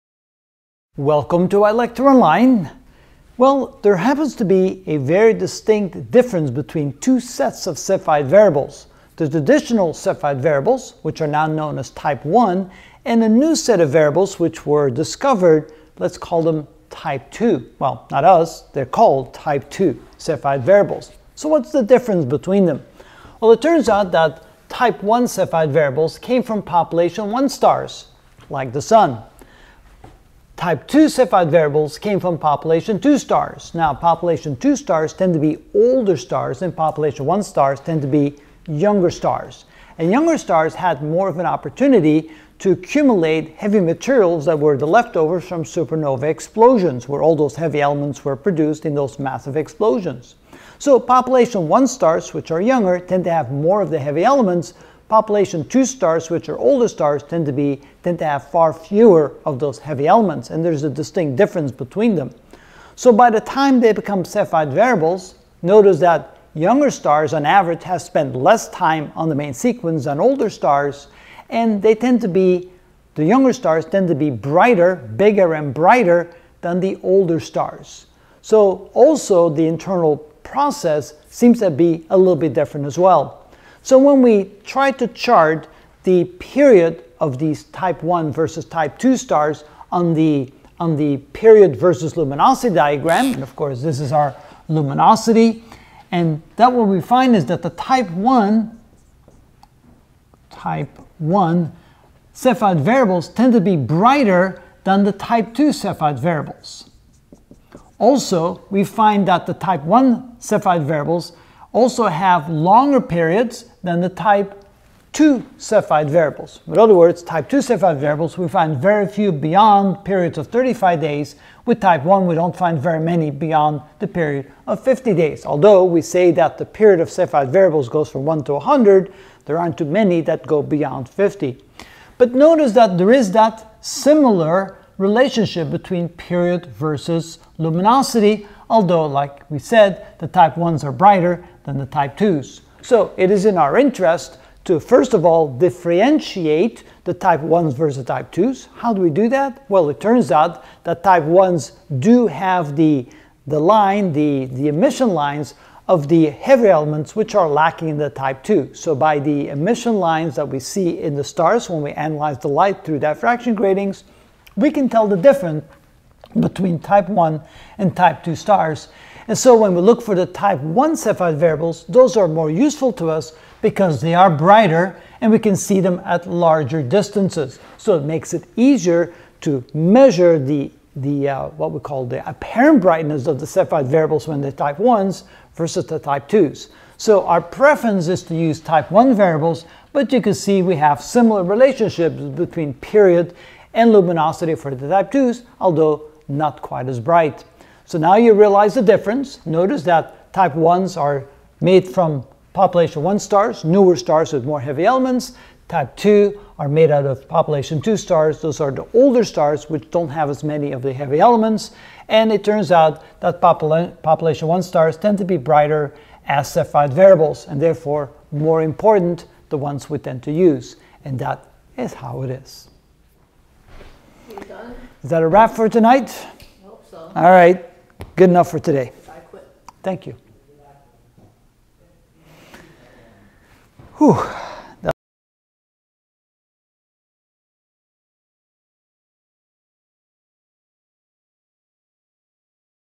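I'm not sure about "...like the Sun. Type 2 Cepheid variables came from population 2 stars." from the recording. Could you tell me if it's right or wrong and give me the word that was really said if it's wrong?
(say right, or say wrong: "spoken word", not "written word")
right.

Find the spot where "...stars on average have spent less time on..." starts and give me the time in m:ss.
1:06.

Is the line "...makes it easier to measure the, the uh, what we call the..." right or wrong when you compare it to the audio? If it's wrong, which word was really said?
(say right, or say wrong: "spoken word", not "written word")
right.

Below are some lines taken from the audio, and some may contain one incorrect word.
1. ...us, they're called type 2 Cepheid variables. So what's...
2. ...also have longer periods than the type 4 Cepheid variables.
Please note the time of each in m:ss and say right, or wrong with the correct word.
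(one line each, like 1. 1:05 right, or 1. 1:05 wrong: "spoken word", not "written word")
1. 0:18 right
2. 1:51 wrong: "2", not "4".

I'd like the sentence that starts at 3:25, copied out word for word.
Type 2 are made out of population 2 stars.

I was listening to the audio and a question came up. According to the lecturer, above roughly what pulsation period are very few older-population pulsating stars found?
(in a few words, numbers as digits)
35 days.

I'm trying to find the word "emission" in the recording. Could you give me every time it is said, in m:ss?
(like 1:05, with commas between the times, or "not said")
2:34, 2:39.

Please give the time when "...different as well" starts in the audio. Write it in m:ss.
1:22.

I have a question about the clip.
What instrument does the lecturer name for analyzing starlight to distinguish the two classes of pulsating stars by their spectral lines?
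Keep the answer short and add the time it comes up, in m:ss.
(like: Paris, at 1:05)
diffraction gratings, at 2:42.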